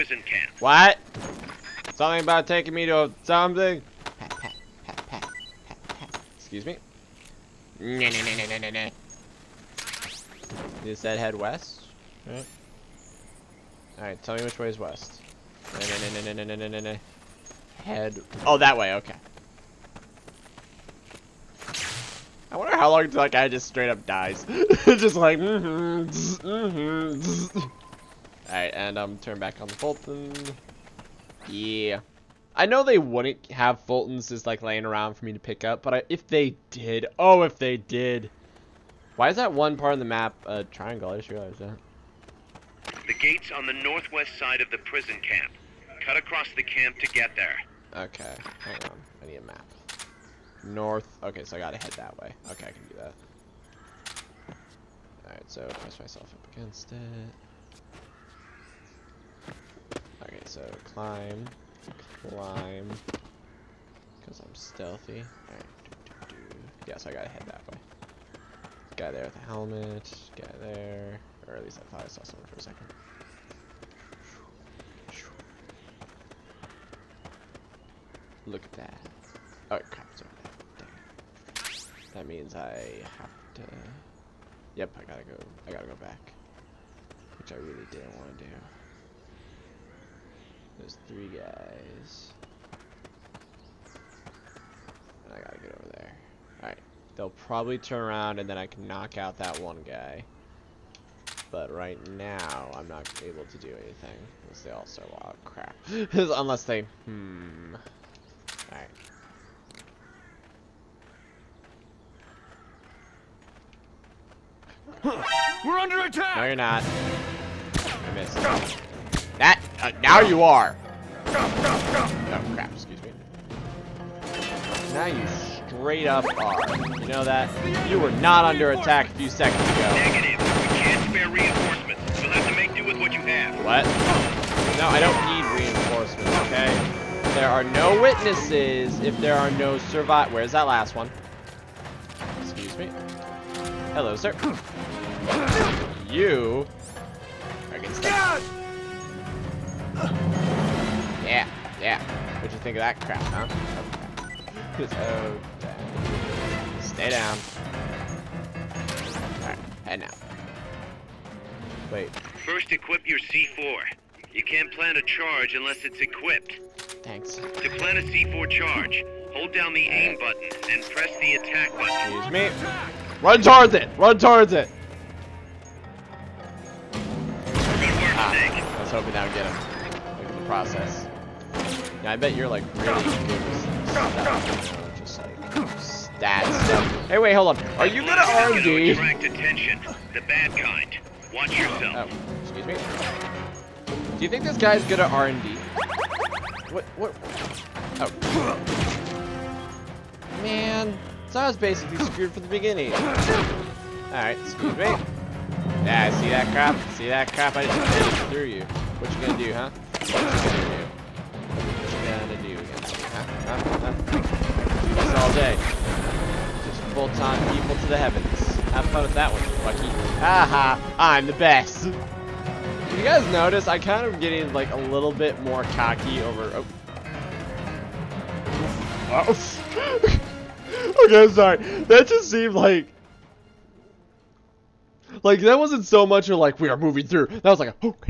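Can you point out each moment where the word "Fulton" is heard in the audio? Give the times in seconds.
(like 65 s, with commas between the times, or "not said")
29 s, 33 s.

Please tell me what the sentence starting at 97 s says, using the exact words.
They'll probably turn around and then I can knock out that one guy.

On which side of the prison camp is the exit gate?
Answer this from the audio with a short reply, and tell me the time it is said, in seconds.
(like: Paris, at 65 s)
northwest, at 43 s.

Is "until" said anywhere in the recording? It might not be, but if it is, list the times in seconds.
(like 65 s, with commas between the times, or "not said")
23 s.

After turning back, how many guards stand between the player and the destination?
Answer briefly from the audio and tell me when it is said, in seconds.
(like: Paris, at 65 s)
3, at 91 s.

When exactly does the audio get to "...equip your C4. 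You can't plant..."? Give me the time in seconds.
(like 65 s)
162 s.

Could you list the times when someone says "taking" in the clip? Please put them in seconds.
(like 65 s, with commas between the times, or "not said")
2 s.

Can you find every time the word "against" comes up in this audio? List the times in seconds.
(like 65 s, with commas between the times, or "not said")
56 s, 212 s.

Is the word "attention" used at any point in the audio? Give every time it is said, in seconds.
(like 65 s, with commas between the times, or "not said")
189 s.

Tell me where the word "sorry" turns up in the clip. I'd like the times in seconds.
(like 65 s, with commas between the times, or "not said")
231 s.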